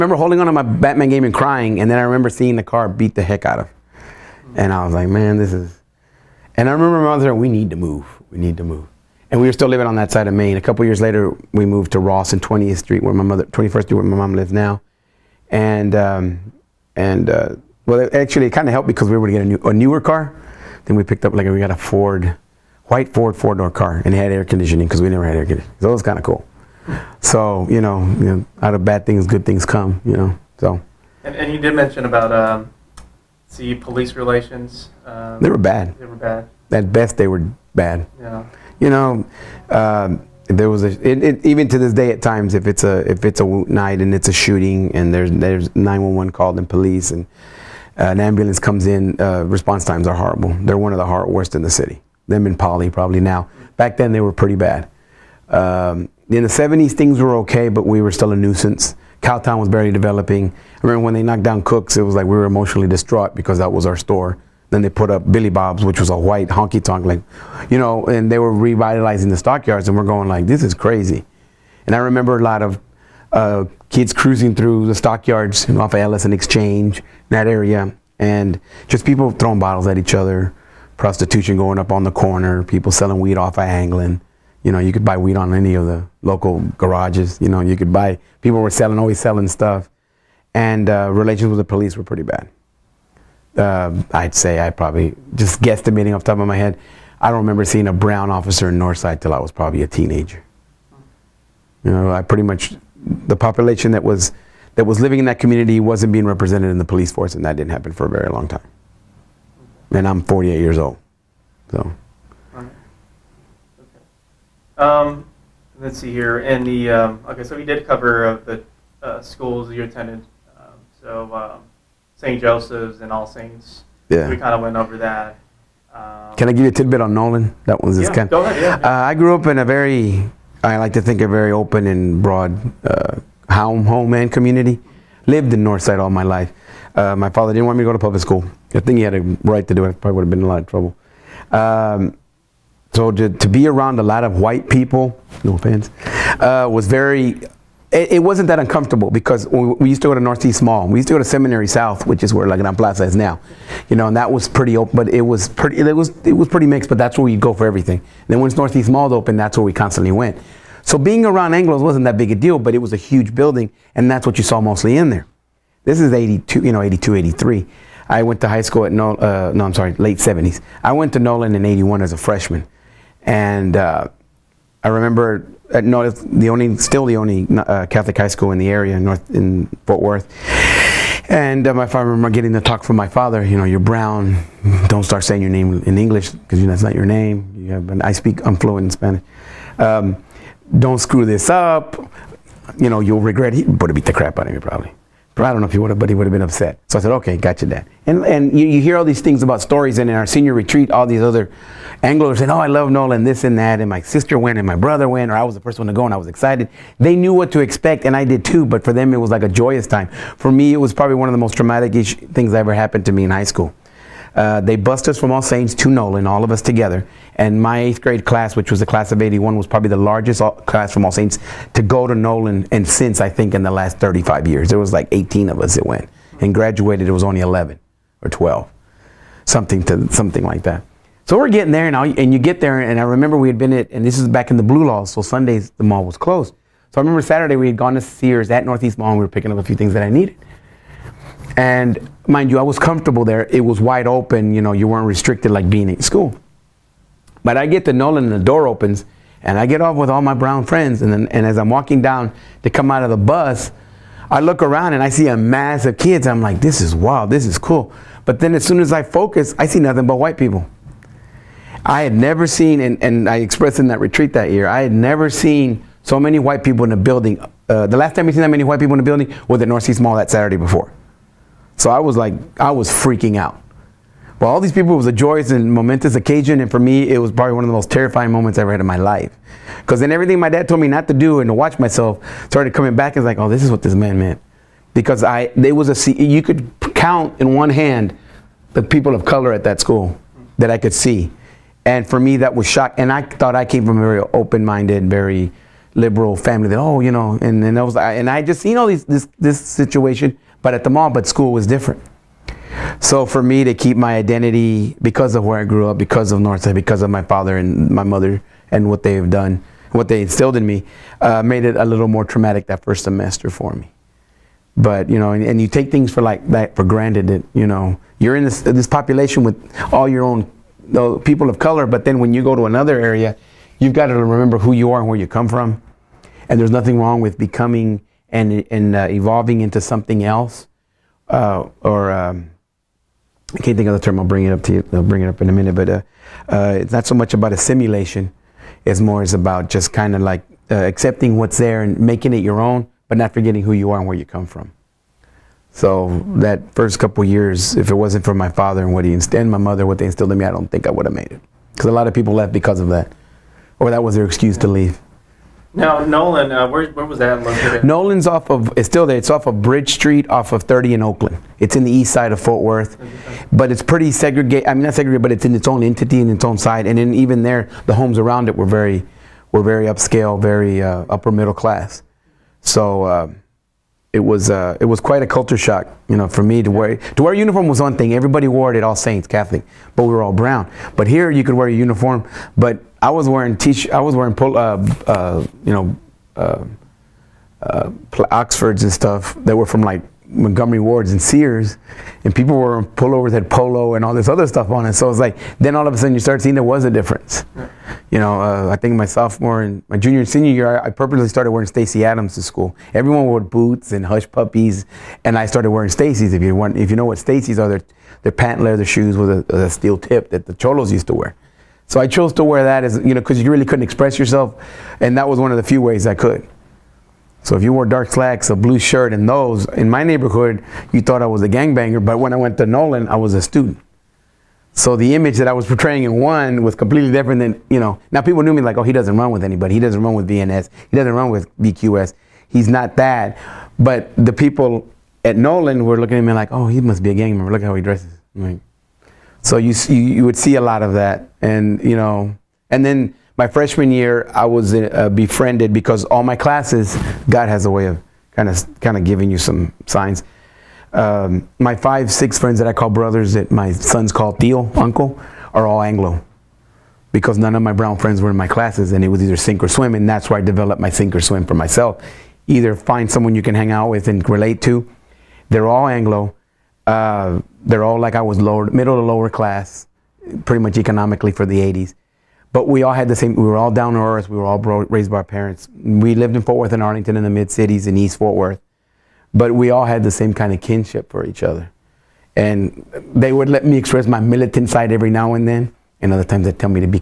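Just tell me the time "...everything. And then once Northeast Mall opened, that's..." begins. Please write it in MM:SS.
02:37.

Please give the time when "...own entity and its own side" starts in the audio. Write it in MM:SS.
06:05.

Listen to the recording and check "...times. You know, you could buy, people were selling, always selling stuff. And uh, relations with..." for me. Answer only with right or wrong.
wrong.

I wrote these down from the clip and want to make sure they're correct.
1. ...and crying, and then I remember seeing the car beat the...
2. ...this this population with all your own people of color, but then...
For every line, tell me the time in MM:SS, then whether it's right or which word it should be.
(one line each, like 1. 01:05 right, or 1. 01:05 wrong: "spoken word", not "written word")
1. 00:01 right
2. 05:18 right.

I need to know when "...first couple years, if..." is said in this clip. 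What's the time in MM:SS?
05:46.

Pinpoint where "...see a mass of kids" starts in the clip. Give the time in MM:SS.
04:15.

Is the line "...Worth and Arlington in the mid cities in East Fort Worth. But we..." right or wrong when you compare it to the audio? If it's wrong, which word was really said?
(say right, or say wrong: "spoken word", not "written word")
right.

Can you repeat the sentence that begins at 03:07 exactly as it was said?
You have, an, I speak, I'm fluent in Spanish.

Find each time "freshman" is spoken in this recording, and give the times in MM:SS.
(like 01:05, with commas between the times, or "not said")
02:52, 07:23.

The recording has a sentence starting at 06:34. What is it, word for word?
So it's like then all of a sudden you start seeing there was a difference.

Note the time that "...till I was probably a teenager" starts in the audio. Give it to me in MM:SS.
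01:39.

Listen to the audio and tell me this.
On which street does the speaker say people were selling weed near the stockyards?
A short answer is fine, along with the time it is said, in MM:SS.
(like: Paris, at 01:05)
Anglin, at 01:23.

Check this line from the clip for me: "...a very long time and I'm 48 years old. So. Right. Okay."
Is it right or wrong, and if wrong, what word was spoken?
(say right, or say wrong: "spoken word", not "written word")
right.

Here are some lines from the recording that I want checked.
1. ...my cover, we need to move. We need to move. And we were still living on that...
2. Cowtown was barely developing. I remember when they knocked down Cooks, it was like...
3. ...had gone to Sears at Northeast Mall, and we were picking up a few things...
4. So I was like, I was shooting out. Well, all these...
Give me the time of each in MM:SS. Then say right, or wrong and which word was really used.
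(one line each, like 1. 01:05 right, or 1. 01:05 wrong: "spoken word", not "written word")
1. 00:07 wrong: "mother", not "cover"
2. 00:59 right
3. 03:57 right
4. 04:31 wrong: "freaking", not "shooting".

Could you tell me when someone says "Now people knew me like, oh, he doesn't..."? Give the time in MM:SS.
07:08.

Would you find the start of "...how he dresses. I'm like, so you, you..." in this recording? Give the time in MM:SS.
07:17.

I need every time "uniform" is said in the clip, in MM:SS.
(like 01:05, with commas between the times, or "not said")
06:17, 06:21.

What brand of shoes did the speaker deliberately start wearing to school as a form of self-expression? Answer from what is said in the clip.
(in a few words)
Stacy Adams.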